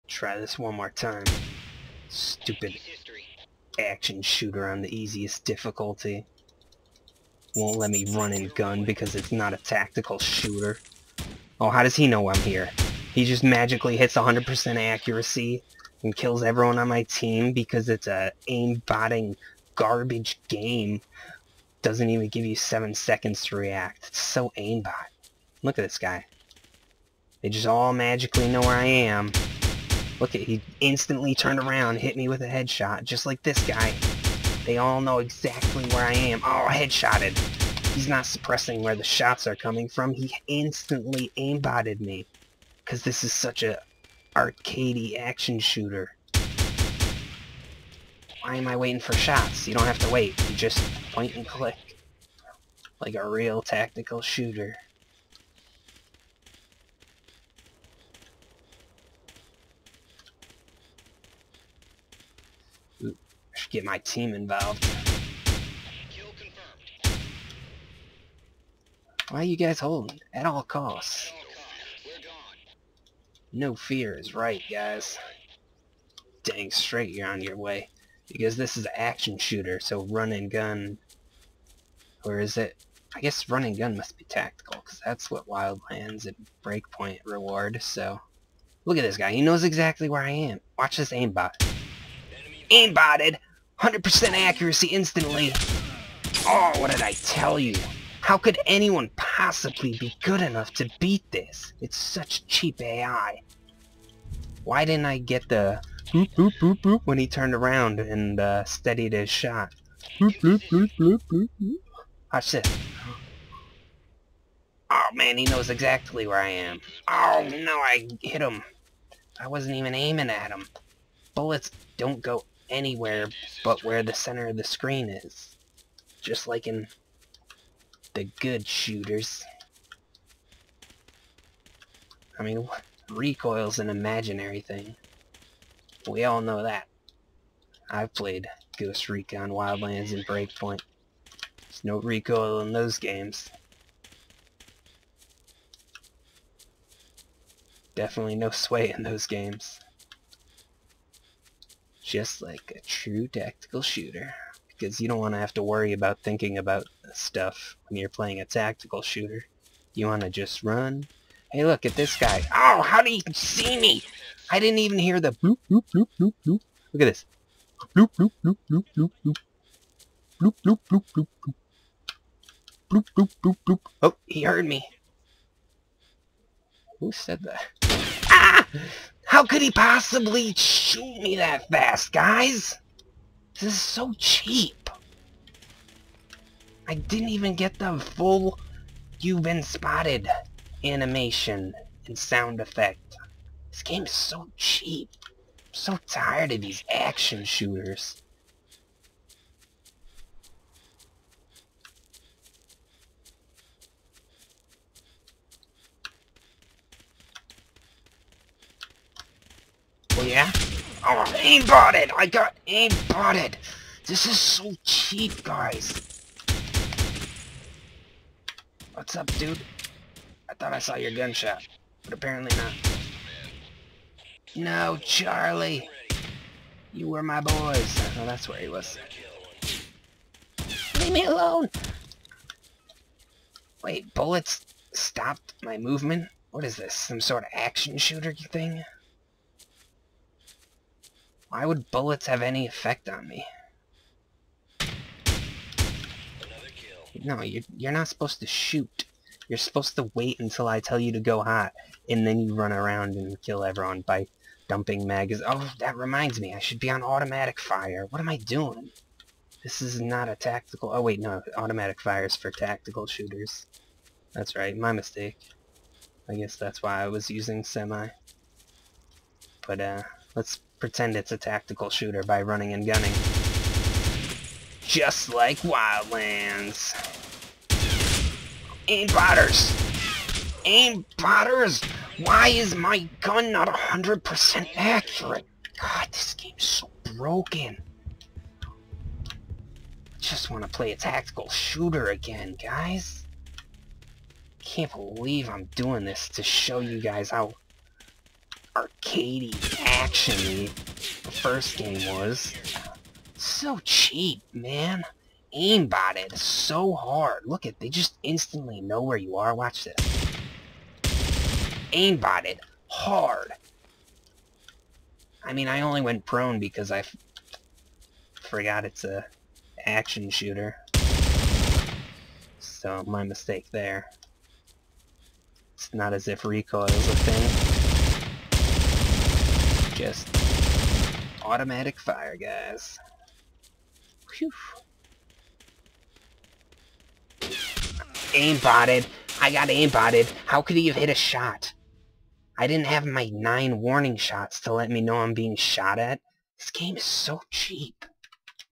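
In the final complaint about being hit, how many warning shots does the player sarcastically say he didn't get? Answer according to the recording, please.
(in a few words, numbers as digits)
9.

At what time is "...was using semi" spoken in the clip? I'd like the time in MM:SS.
04:27.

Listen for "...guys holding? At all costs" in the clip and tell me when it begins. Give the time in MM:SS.
01:09.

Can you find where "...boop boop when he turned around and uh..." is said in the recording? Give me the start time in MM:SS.
01:46.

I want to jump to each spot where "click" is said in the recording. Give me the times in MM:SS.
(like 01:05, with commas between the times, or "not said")
00:51.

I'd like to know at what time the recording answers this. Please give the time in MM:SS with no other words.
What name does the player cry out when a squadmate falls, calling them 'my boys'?
03:44.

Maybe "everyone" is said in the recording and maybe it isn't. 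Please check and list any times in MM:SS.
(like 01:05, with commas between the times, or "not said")
00:16, 04:13.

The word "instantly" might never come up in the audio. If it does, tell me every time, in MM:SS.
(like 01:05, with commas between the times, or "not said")
00:30, 00:40, 01:34, 05:08.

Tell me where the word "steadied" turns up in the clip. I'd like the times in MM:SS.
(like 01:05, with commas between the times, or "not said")
01:48.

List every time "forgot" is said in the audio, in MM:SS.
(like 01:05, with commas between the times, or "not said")
05:18.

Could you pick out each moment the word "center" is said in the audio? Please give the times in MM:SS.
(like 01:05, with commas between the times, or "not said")
02:04.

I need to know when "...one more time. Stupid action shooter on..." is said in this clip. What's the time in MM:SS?
00:00.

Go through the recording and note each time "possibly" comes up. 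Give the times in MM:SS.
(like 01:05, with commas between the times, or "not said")
01:39, 02:59.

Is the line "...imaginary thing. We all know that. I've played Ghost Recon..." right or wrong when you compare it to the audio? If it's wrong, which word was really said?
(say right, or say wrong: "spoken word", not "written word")
right.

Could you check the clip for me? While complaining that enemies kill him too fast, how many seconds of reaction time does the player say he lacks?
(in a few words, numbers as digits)
7.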